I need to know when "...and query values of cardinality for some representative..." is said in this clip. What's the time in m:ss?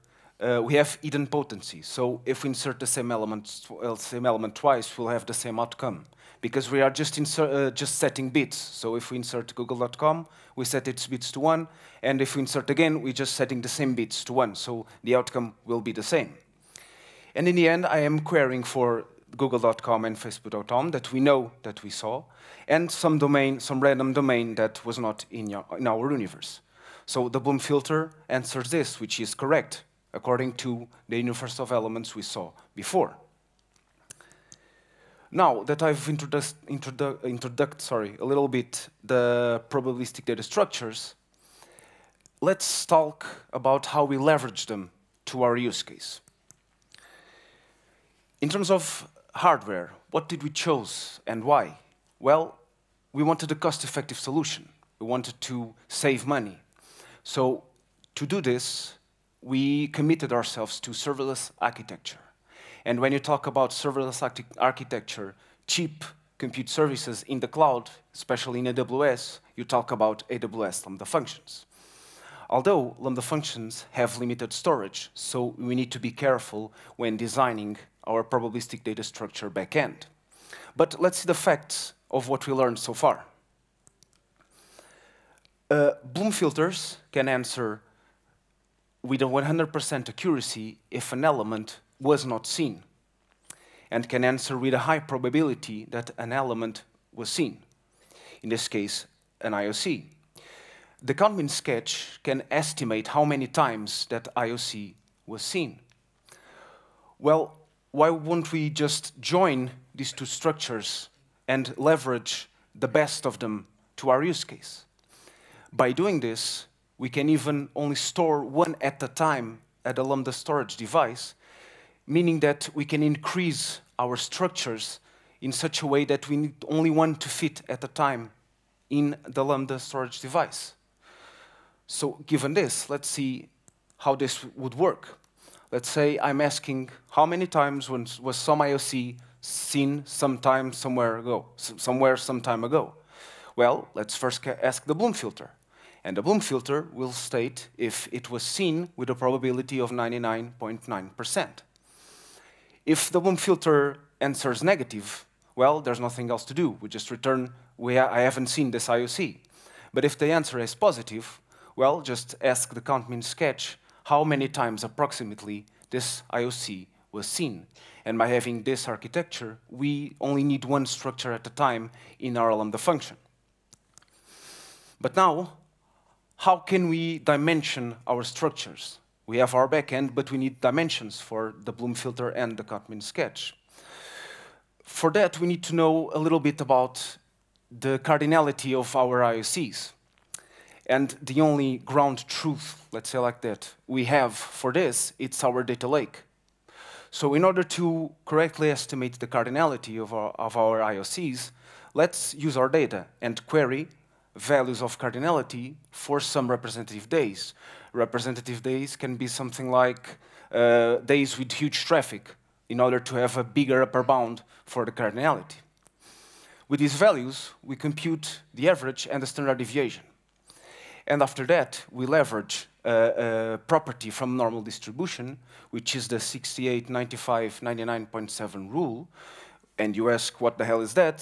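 3:23.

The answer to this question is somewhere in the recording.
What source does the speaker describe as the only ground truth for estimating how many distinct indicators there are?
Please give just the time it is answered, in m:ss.
3:15.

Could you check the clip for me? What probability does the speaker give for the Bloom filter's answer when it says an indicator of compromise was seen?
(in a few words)
99.9%.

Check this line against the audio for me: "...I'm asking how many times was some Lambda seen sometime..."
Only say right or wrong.
wrong.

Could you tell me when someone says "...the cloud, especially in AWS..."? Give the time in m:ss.
1:07.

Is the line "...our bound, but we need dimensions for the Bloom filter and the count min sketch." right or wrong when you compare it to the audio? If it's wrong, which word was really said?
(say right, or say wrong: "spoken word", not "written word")
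wrong: "backend", not "bound".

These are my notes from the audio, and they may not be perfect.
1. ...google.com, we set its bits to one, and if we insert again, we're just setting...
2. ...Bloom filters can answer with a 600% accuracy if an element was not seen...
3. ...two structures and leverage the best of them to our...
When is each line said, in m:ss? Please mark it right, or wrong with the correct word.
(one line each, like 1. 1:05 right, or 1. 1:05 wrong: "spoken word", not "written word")
1. 0:09 right
2. 1:26 wrong: "100", not "600"
3. 1:50 right.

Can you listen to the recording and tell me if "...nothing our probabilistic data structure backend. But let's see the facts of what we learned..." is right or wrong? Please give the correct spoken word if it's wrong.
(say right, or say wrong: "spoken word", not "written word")
wrong: "designing", not "nothing".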